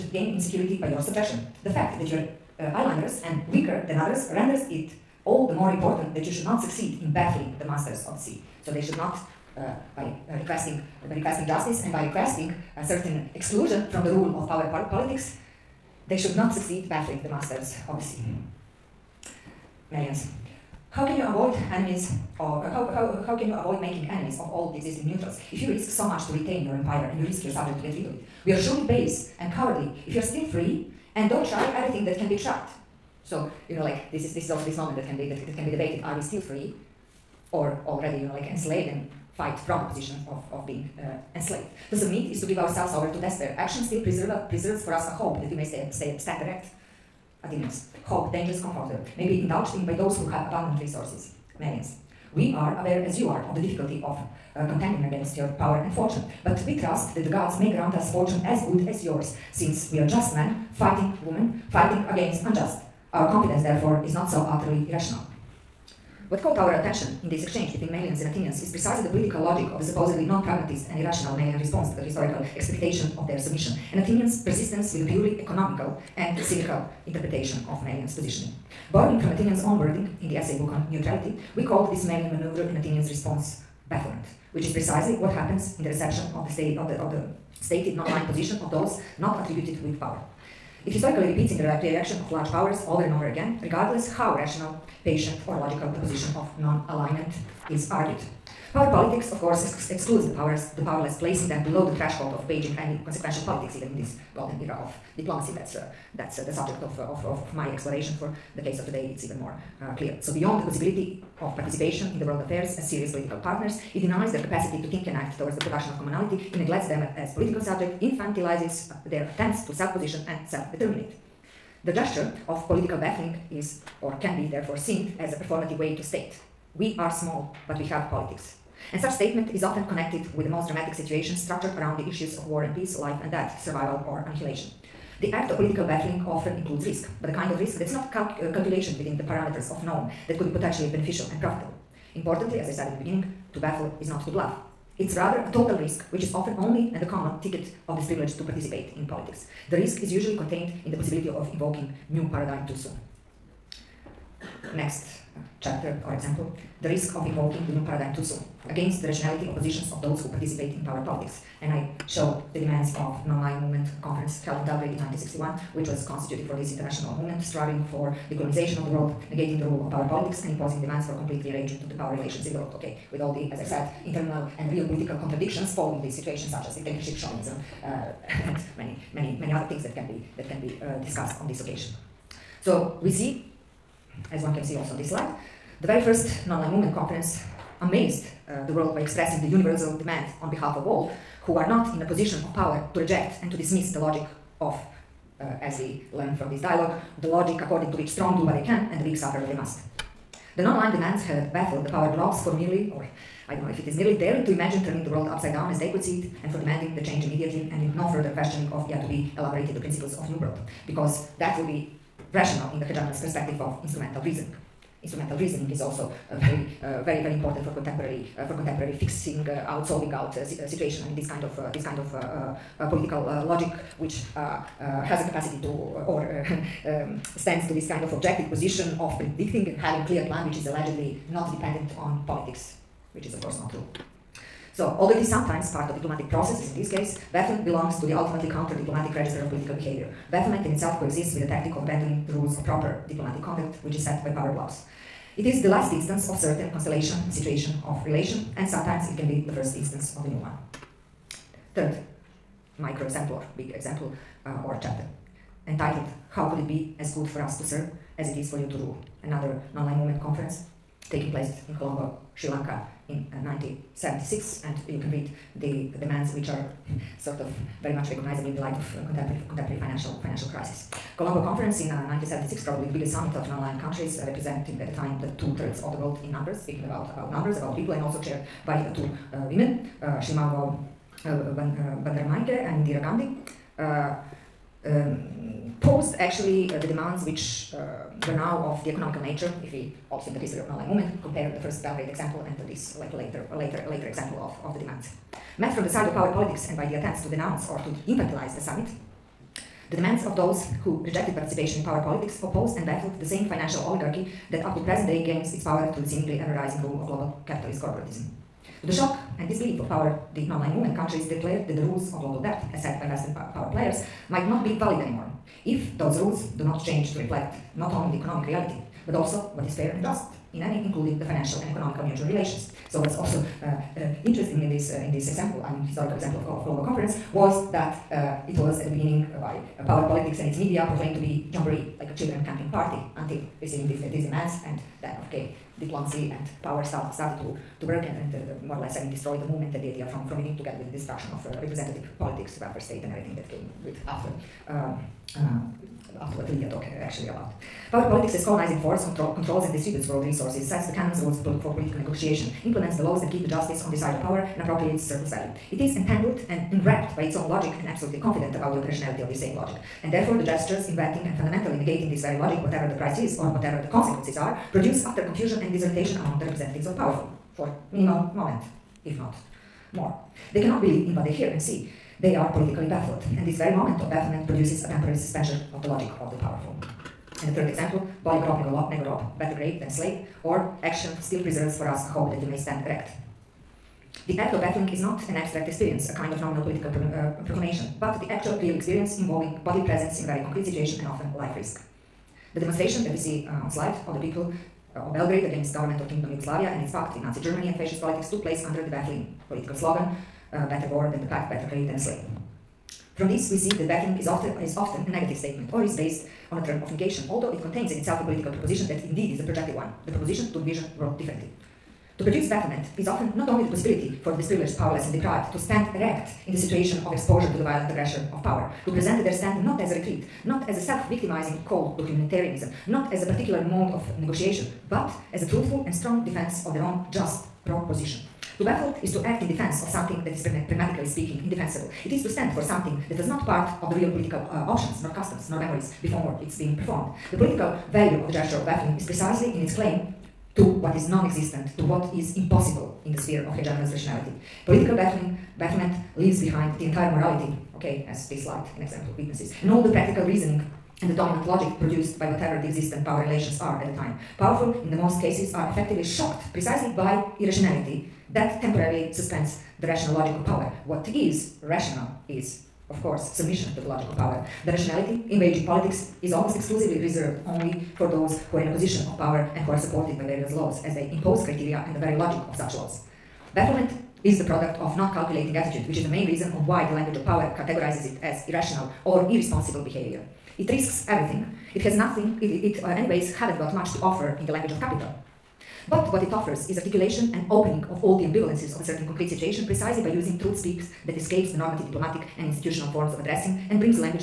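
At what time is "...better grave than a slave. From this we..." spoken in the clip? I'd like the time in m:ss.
6:41.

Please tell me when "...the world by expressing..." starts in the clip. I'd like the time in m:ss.
3:08.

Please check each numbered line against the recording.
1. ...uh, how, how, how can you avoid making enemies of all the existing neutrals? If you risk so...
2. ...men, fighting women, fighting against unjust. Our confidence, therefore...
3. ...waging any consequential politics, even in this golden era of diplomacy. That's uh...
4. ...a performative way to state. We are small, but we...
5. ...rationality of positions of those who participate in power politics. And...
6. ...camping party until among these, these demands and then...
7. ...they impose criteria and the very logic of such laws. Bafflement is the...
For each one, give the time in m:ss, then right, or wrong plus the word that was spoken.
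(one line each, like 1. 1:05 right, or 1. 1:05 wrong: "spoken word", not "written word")
1. 0:22 right
2. 1:00 right
3. 1:42 right
4. 2:05 right
5. 2:39 right
6. 5:32 wrong: "receiving", not "among"
7. 7:50 right.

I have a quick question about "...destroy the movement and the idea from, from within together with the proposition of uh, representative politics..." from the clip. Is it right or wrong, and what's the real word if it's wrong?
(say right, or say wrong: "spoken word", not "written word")
wrong: "destruction", not "proposition".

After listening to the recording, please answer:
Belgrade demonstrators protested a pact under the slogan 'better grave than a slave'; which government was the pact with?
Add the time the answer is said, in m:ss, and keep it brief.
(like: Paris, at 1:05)
Nazi Germany, at 6:37.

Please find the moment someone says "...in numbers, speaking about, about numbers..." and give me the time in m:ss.
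4:36.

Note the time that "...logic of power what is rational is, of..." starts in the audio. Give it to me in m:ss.
7:40.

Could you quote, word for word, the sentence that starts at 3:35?
Instrumental reasoning is also very, very, very important for contemporary, uh, for contemporary fixing uh, out, solving out uh, situation.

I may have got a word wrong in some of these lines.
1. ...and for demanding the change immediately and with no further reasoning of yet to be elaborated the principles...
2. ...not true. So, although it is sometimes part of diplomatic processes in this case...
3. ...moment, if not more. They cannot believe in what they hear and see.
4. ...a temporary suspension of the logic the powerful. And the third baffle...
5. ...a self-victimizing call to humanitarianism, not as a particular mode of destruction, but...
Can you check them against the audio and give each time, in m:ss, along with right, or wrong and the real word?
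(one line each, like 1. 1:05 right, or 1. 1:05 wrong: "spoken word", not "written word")
1. 3:26 wrong: "questioning", not "reasoning"
2. 3:53 right
3. 6:08 right
4. 6:14 wrong: "example", not "baffle"
5. 7:00 wrong: "negotiation", not "destruction".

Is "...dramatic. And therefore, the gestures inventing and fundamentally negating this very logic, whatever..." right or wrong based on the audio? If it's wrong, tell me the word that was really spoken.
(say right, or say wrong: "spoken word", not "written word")
wrong: "logic", not "dramatic".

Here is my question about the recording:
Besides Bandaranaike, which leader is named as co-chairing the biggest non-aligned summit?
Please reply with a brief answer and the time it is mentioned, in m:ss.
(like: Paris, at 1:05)
Indira Gandhi, at 4:42.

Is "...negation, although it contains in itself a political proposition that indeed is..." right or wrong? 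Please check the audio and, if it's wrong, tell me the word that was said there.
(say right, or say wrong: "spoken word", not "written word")
right.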